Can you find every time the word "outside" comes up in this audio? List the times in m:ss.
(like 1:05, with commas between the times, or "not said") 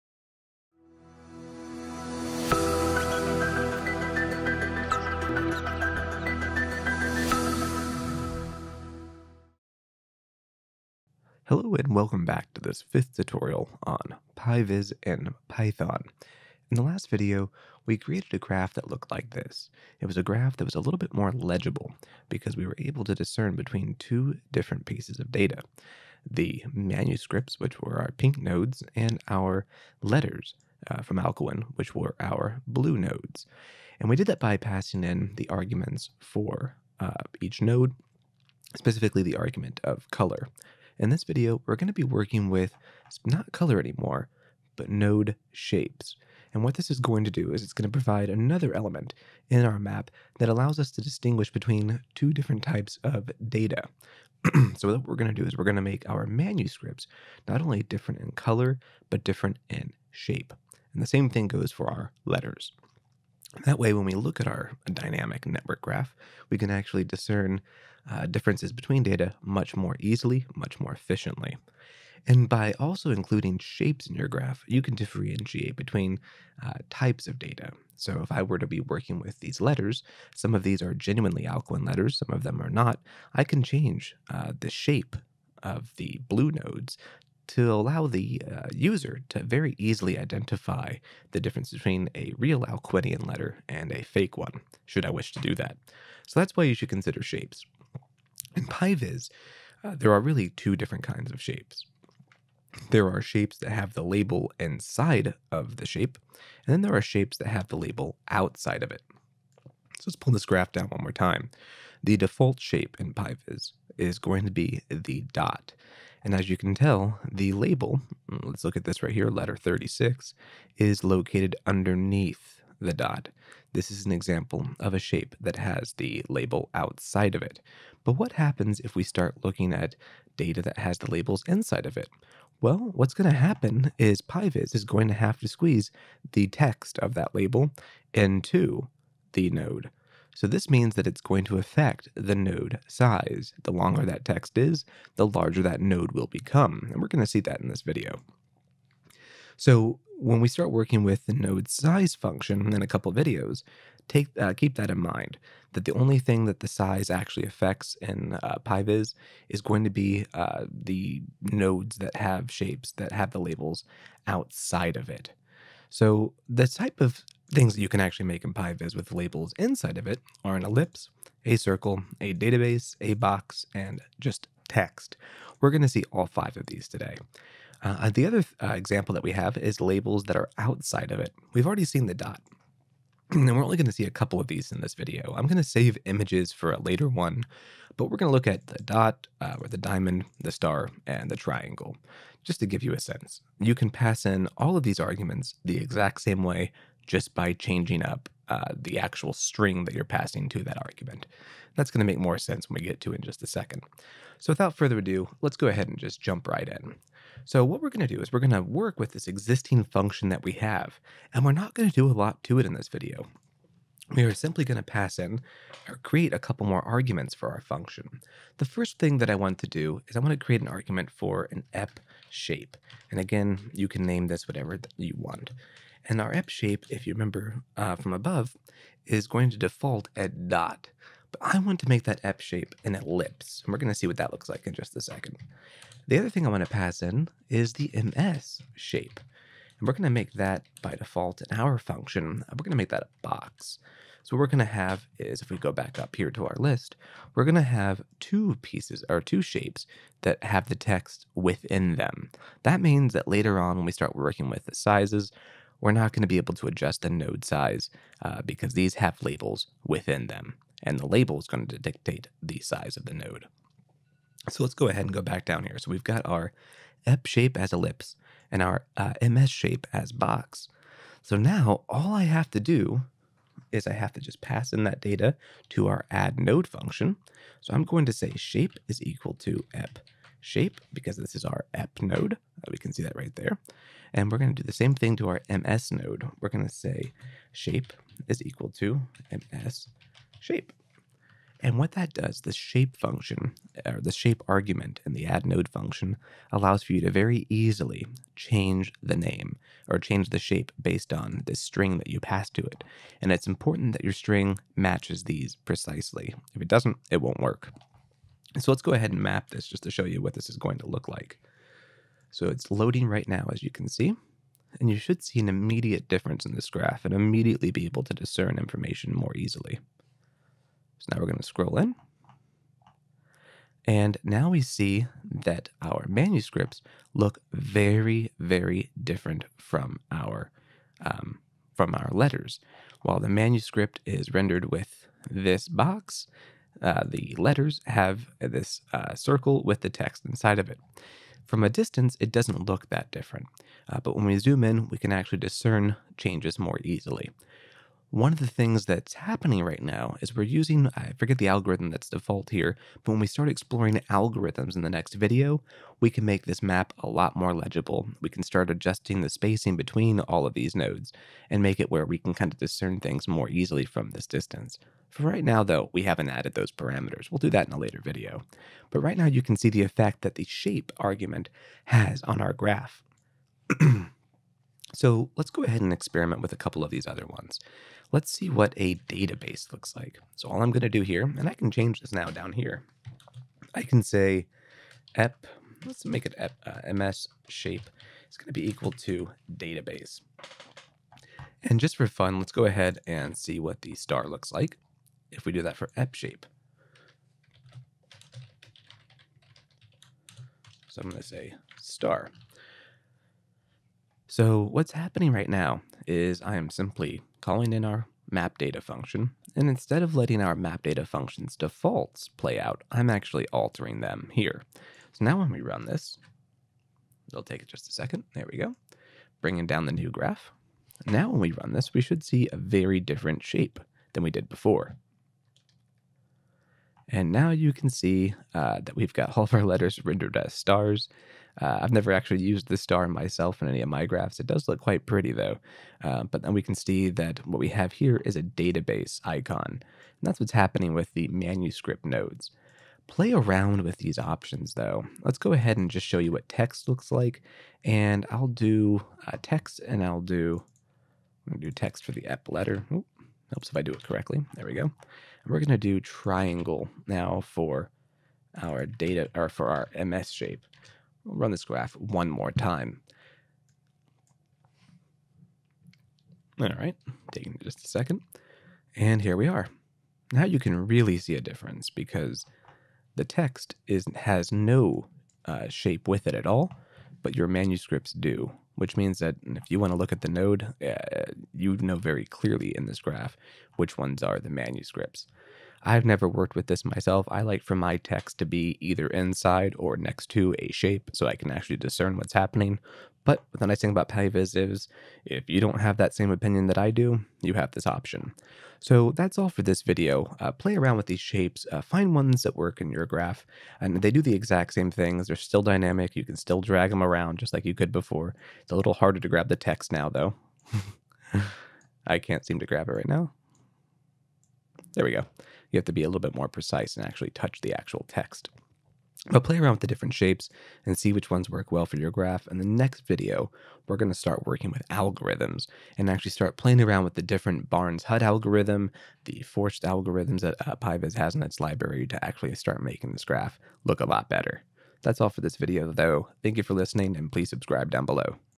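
1:48, 2:06, 2:44, 3:00.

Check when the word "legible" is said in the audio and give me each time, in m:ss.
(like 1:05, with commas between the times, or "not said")
0:21, 5:57.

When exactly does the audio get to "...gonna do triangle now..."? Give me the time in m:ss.
7:35.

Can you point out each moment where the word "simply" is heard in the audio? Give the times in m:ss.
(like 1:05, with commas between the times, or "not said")
3:34, 6:46.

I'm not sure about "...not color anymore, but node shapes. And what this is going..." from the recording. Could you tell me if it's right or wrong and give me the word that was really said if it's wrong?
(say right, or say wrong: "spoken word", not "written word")
right.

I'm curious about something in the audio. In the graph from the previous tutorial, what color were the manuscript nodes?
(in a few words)
pink.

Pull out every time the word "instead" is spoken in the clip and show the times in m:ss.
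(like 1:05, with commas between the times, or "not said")
6:49.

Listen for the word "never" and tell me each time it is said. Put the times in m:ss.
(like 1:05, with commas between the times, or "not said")
7:11, 8:06.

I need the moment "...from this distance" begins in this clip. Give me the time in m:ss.
6:03.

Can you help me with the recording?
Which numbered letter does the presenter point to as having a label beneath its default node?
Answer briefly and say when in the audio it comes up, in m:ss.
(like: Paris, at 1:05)
letter 36, at 1:59.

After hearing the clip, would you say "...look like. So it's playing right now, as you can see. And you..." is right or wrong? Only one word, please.
wrong.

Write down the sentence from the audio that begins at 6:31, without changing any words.
And just for fun, let's go ahead and see what the star looks like if we do that for ep shape.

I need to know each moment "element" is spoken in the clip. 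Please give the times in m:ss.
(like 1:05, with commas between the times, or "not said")
0:48.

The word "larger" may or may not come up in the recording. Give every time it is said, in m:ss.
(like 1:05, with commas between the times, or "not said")
2:25.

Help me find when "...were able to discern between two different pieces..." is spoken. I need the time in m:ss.
0:22.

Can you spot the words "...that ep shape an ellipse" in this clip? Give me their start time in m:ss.
3:52.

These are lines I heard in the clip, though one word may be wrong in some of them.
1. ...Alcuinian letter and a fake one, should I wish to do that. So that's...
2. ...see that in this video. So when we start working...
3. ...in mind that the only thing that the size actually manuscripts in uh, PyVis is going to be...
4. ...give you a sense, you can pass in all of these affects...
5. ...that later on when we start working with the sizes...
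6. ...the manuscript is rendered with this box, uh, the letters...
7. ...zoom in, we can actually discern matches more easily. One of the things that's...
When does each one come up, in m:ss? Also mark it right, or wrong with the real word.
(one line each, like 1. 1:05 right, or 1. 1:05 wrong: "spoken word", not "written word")
1. 1:32 right
2. 2:27 right
3. 2:34 wrong: "affects", not "manuscripts"
4. 3:12 wrong: "arguments", not "affects"
5. 4:13 right
6. 5:33 right
7. 5:44 wrong: "changes", not "matches".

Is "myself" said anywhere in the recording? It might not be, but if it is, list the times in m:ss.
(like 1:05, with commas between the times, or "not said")
7:13, 8:06.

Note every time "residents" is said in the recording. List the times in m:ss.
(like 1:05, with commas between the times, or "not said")
not said.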